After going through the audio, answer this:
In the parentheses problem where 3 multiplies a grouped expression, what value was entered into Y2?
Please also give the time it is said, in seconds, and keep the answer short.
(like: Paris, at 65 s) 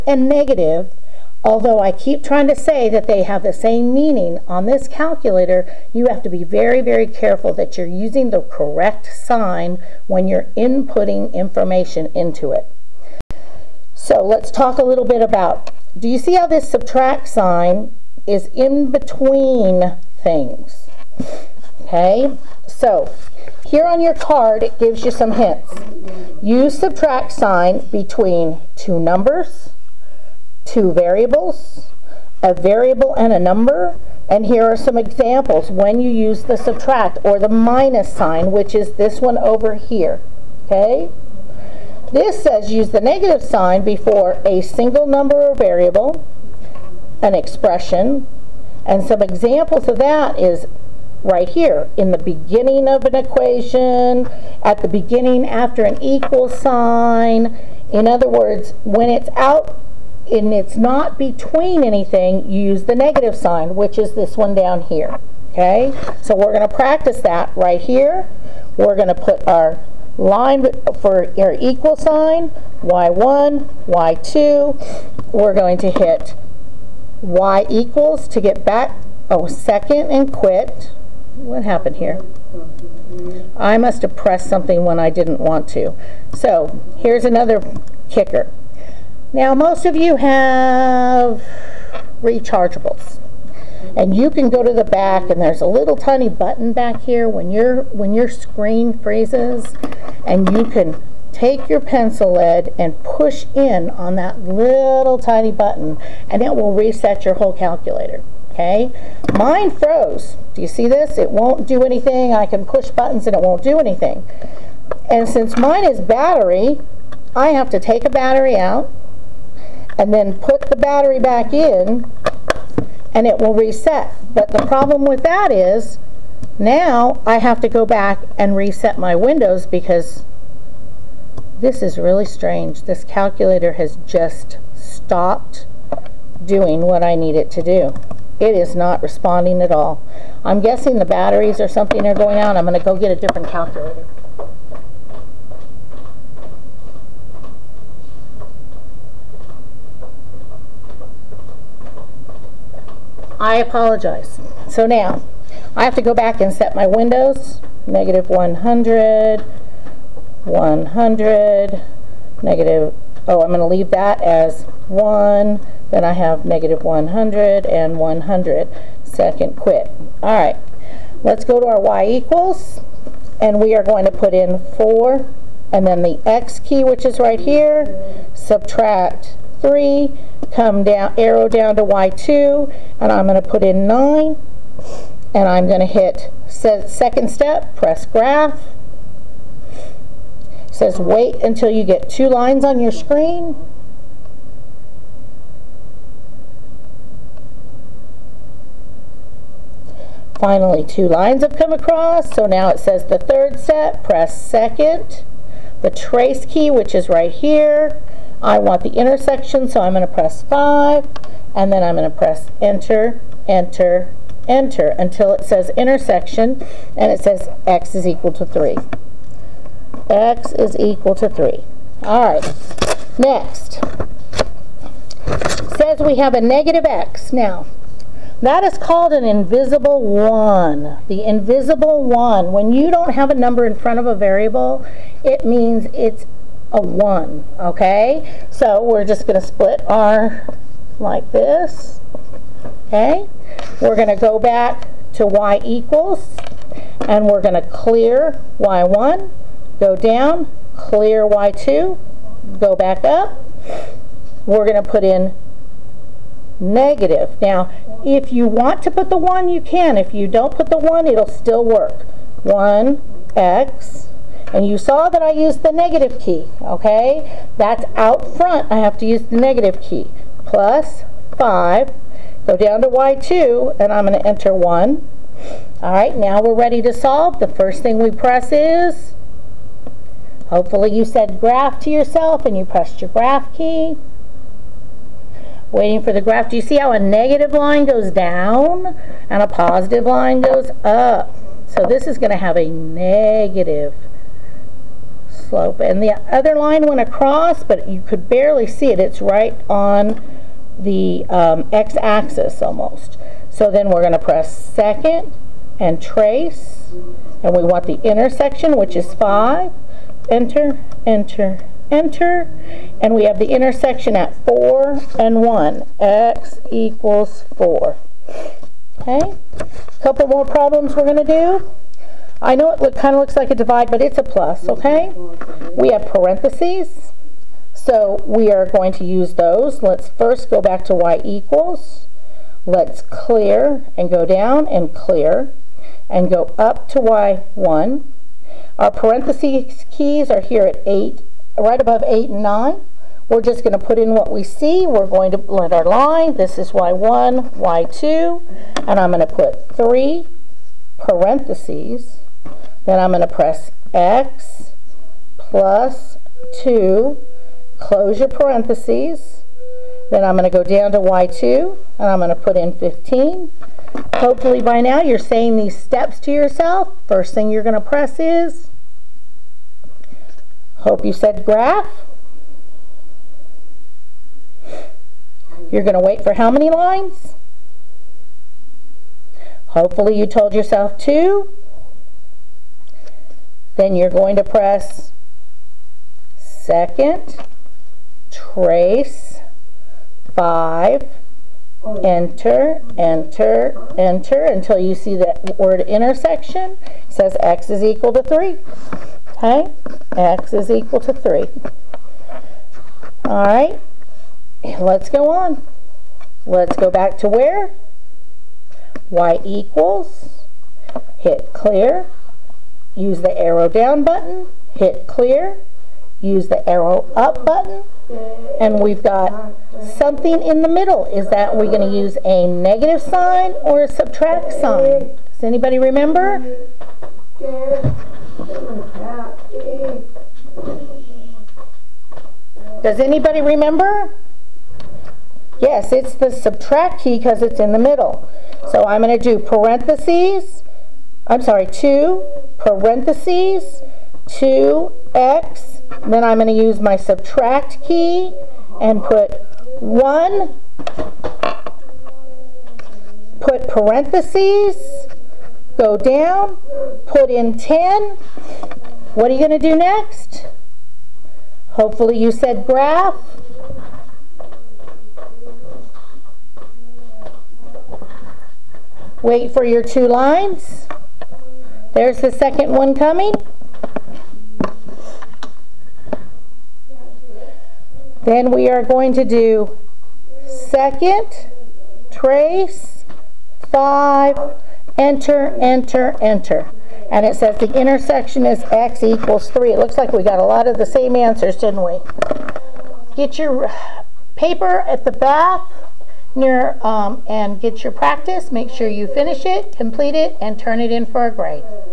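15, at 362 s.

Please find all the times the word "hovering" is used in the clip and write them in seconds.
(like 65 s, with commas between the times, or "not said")
not said.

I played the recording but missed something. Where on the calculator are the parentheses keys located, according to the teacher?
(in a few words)
above 8 and 9.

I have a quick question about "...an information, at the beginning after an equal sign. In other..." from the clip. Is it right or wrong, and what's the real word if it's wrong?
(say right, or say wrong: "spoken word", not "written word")
wrong: "equation", not "information".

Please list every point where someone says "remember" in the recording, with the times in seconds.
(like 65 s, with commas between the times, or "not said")
425 s, 433 s.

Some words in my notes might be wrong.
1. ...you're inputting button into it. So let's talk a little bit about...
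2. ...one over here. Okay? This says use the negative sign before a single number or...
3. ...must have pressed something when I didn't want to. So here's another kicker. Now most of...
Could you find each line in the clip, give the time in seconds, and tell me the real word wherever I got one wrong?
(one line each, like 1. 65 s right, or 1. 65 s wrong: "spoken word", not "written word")
1. 10 s wrong: "information", not "button"
2. 39 s right
3. 83 s right.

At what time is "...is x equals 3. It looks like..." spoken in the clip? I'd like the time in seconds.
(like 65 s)
488 s.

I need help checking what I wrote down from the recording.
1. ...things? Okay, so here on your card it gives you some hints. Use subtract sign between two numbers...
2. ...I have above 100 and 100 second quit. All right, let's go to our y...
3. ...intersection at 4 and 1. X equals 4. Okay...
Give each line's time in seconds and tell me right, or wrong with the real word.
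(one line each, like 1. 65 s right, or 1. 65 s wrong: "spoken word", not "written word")
1. 20 s right
2. 166 s wrong: "negative", not "above"
3. 313 s right.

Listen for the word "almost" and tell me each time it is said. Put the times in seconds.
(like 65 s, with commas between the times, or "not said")
302 s.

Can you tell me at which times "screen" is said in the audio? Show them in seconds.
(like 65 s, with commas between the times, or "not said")
98 s, 192 s.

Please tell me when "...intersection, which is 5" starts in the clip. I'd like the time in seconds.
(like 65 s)
308 s.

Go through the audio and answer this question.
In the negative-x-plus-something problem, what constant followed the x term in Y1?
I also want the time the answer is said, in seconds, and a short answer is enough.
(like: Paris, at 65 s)
5, at 270 s.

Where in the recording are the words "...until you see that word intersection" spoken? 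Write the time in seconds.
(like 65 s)
394 s.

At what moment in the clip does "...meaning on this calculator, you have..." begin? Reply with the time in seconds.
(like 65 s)
3 s.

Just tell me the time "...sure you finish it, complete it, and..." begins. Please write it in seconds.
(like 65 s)
498 s.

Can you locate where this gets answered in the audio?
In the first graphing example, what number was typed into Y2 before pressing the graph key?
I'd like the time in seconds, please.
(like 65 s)
183 s.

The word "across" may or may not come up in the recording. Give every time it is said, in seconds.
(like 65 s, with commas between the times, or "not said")
201 s, 297 s.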